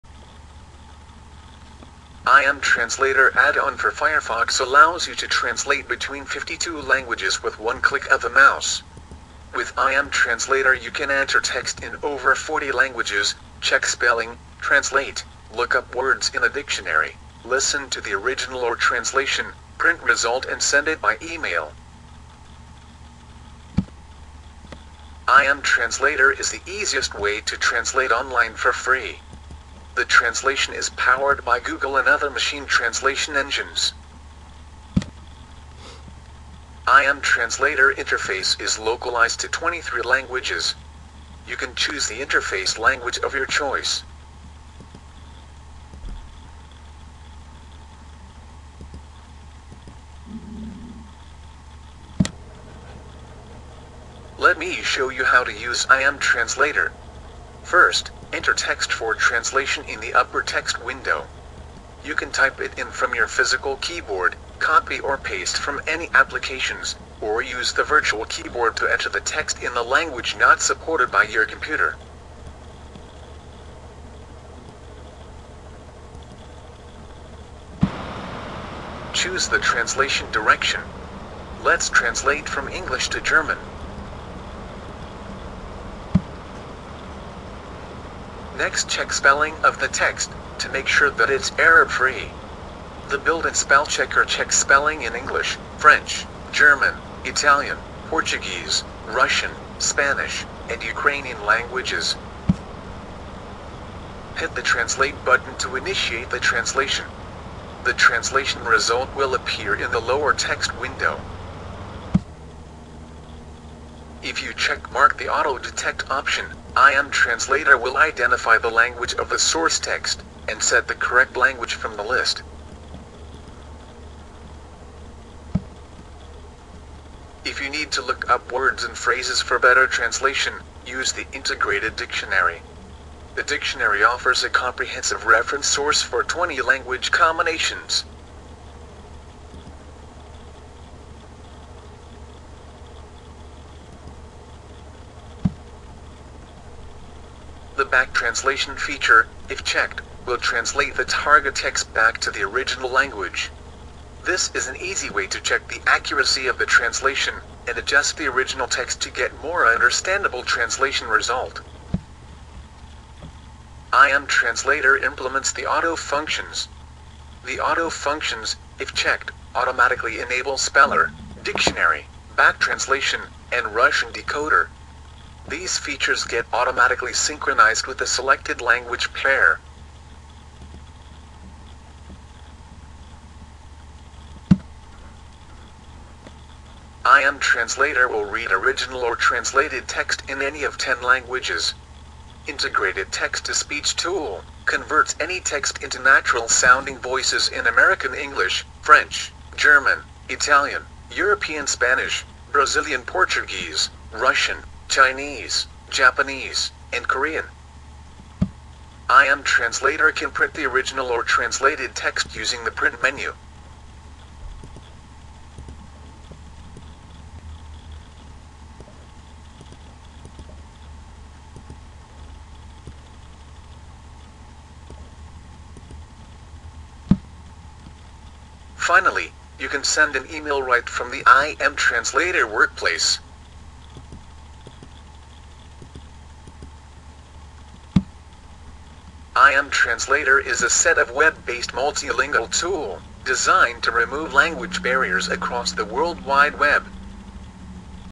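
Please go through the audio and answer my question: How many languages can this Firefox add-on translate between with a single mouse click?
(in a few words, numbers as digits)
52.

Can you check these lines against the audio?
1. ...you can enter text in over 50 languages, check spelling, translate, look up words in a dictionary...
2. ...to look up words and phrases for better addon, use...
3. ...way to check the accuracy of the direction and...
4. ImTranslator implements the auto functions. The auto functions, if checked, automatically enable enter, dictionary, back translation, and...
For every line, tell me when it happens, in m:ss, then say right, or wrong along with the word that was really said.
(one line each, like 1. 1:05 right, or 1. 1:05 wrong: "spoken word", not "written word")
1. 0:10 wrong: "40", not "50"
2. 2:07 wrong: "translation", not "addon"
3. 2:35 wrong: "translation", not "direction"
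4. 2:43 wrong: "speller", not "enter".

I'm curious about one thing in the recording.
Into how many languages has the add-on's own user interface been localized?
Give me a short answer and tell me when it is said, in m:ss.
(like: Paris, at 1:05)
23, at 0:39.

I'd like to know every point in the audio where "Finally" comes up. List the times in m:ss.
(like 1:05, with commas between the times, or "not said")
3:48.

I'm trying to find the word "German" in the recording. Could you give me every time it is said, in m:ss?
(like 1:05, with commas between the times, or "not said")
1:23, 1:36, 3:19.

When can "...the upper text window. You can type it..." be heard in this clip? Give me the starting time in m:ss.
0:59.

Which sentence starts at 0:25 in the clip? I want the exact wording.
ImTranslator is the easiest way to translate online for free the translation is powered by Google and other machine translation engines.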